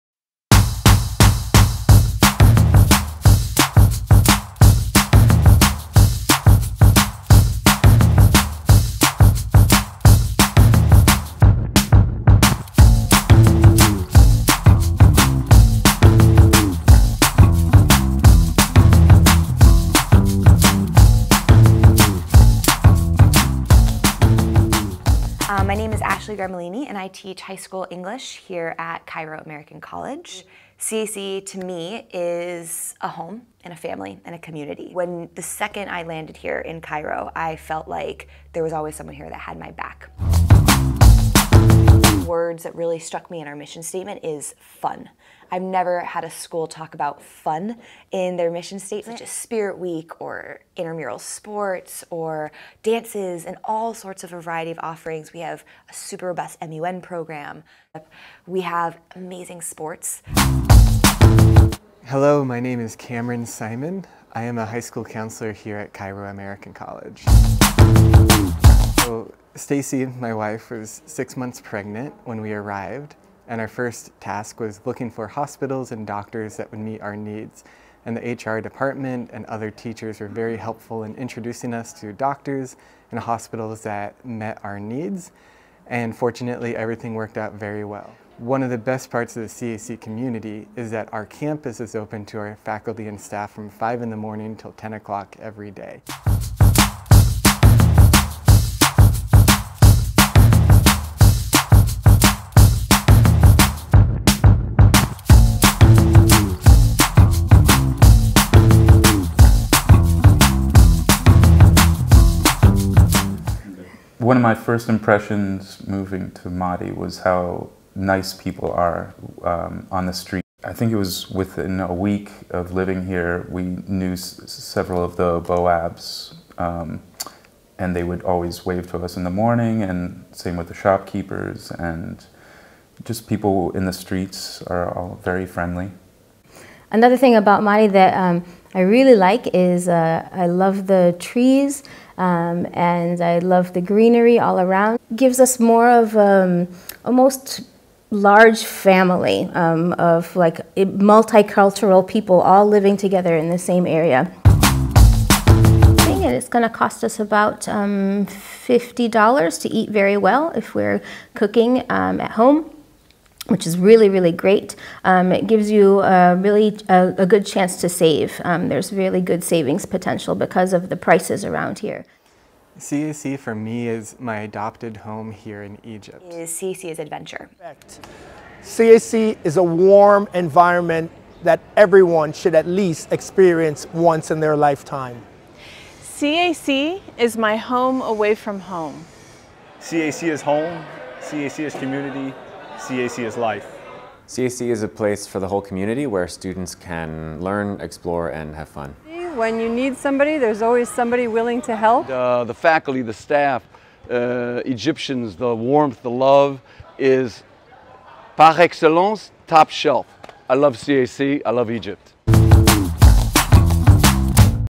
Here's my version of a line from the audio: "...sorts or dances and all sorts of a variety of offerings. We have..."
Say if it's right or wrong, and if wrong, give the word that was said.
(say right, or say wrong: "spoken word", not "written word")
wrong: "sports", not "sorts".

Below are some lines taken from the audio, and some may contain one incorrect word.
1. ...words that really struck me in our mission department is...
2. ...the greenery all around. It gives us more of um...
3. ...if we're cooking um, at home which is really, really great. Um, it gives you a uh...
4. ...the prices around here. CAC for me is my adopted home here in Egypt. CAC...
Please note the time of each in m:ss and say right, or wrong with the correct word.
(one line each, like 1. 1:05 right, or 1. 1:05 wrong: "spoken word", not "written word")
1. 0:42 wrong: "statement", not "department"
2. 2:23 right
3. 2:40 right
4. 2:50 right.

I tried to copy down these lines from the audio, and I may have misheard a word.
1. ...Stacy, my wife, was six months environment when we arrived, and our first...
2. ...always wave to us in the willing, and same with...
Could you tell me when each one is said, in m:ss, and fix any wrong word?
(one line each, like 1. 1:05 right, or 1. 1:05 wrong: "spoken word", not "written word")
1. 1:09 wrong: "pregnant", not "environment"
2. 2:08 wrong: "morning", not "willing".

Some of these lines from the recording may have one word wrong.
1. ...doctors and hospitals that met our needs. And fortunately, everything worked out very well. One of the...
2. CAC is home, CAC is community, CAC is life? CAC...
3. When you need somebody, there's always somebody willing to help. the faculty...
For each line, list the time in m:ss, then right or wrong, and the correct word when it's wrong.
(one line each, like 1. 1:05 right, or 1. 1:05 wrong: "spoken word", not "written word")
1. 1:22 right
2. 3:09 right
3. 3:19 right.